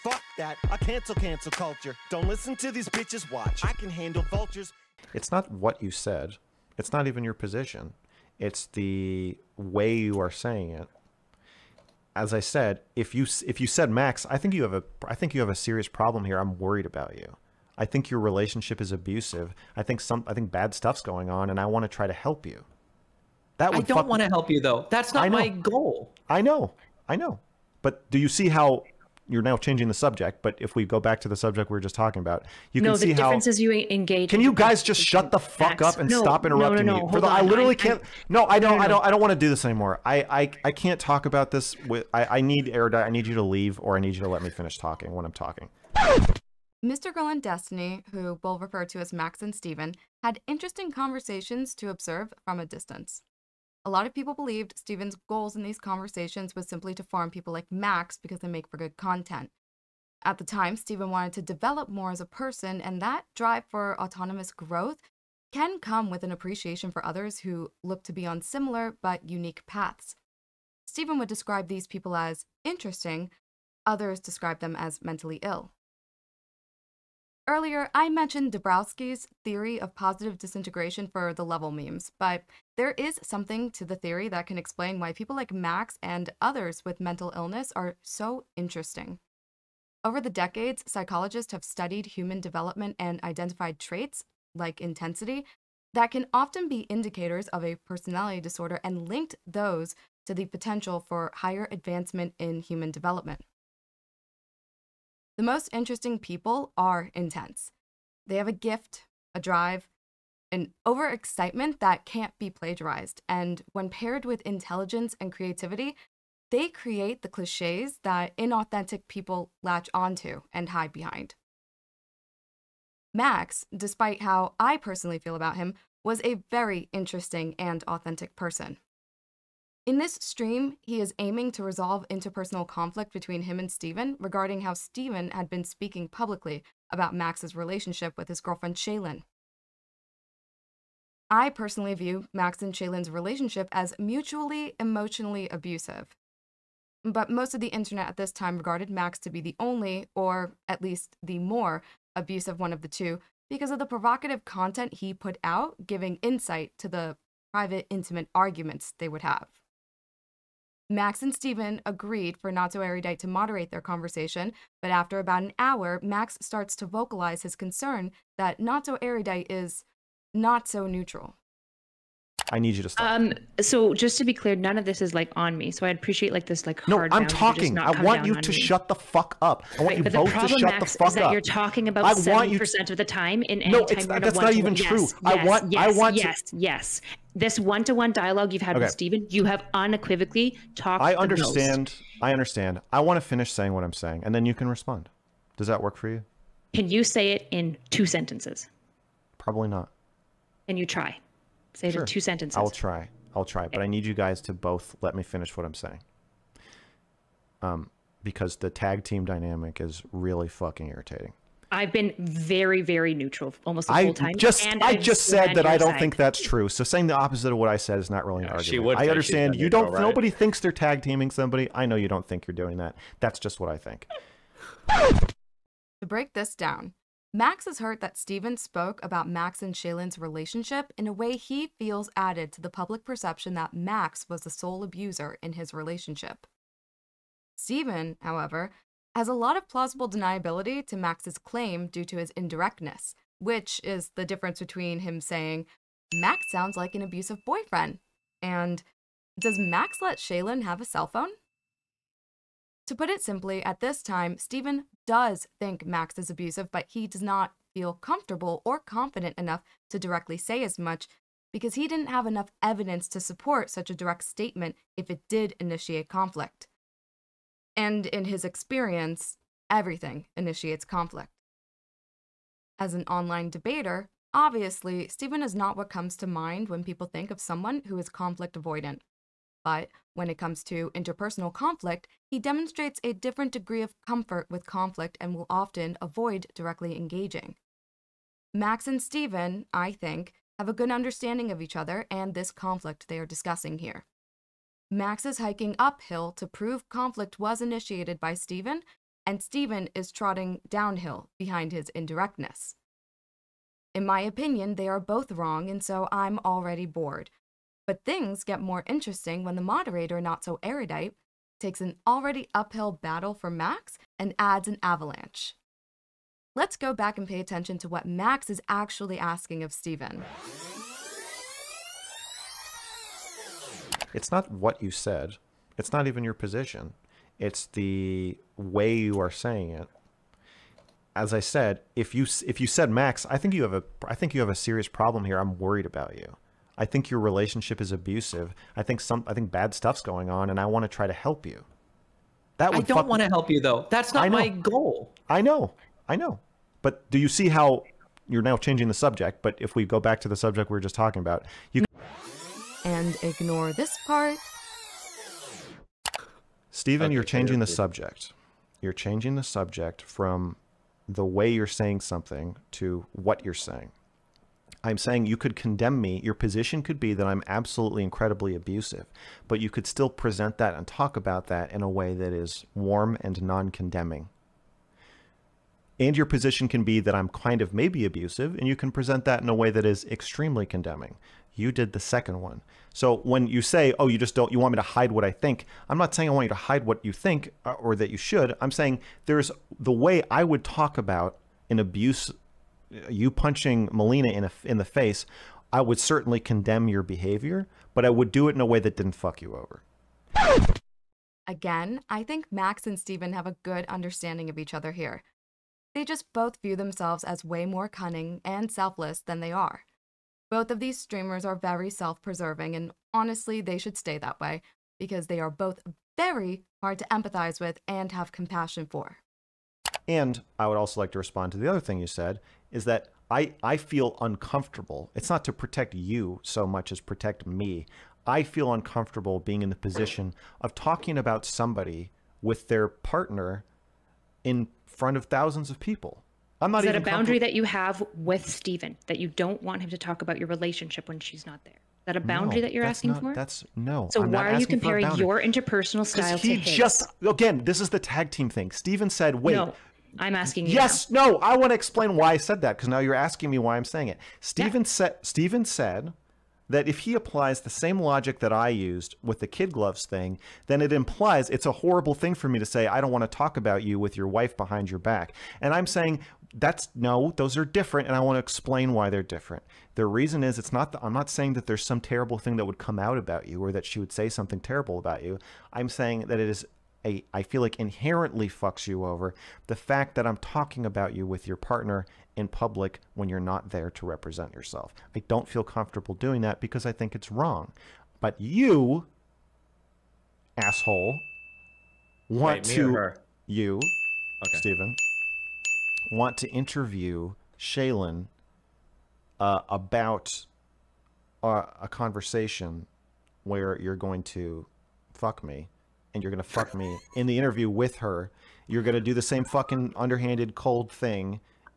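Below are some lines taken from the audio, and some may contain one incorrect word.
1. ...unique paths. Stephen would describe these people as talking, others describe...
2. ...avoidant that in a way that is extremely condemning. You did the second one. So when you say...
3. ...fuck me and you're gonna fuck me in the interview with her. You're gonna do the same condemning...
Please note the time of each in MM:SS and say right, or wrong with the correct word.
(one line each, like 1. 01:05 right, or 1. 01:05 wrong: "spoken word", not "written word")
1. 01:09 wrong: "interesting", not "talking"
2. 06:18 wrong: "present", not "avoidant"
3. 08:25 wrong: "fucking", not "condemning".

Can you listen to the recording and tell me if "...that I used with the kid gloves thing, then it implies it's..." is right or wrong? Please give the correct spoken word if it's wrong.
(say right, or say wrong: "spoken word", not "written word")
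right.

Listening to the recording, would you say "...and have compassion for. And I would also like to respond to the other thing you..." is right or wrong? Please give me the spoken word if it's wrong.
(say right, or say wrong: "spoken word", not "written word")
right.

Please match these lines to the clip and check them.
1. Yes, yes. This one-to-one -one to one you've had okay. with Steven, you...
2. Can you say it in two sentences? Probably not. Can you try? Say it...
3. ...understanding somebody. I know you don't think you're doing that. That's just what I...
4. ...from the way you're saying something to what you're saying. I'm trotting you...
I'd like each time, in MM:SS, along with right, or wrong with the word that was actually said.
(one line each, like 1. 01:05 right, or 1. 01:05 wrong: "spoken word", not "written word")
1. 03:06 right
2. 03:16 right
3. 03:41 wrong: "teaming", not "understanding"
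4. 06:00 wrong: "saying", not "trotting".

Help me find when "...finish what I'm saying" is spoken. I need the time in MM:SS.
03:25.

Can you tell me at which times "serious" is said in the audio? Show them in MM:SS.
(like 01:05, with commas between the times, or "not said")
00:15, 05:34.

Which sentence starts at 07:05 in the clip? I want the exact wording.
It's not to protect you so much as protect me.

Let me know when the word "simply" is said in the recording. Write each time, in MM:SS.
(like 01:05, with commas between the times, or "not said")
00:56, 04:13.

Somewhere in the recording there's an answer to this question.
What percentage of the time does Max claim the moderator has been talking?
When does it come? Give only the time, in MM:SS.
03:02.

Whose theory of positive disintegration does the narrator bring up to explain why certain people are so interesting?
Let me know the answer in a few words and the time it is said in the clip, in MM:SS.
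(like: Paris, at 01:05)
Dabrowski, at 01:18.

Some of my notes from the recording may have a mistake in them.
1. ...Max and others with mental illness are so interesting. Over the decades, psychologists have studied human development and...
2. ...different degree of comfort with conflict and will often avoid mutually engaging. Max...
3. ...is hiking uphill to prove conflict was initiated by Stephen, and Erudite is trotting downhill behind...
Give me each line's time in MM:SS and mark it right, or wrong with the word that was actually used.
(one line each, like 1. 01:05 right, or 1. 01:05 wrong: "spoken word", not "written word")
1. 01:25 right
2. 04:43 wrong: "directly", not "mutually"
3. 04:55 wrong: "Stephen", not "Erudite".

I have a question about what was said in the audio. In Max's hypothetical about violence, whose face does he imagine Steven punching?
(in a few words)
Melina.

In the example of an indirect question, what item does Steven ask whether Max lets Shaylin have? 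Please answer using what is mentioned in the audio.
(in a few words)
A cell phone.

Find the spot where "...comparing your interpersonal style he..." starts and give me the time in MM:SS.
07:24.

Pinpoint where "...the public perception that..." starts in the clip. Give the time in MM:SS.
03:52.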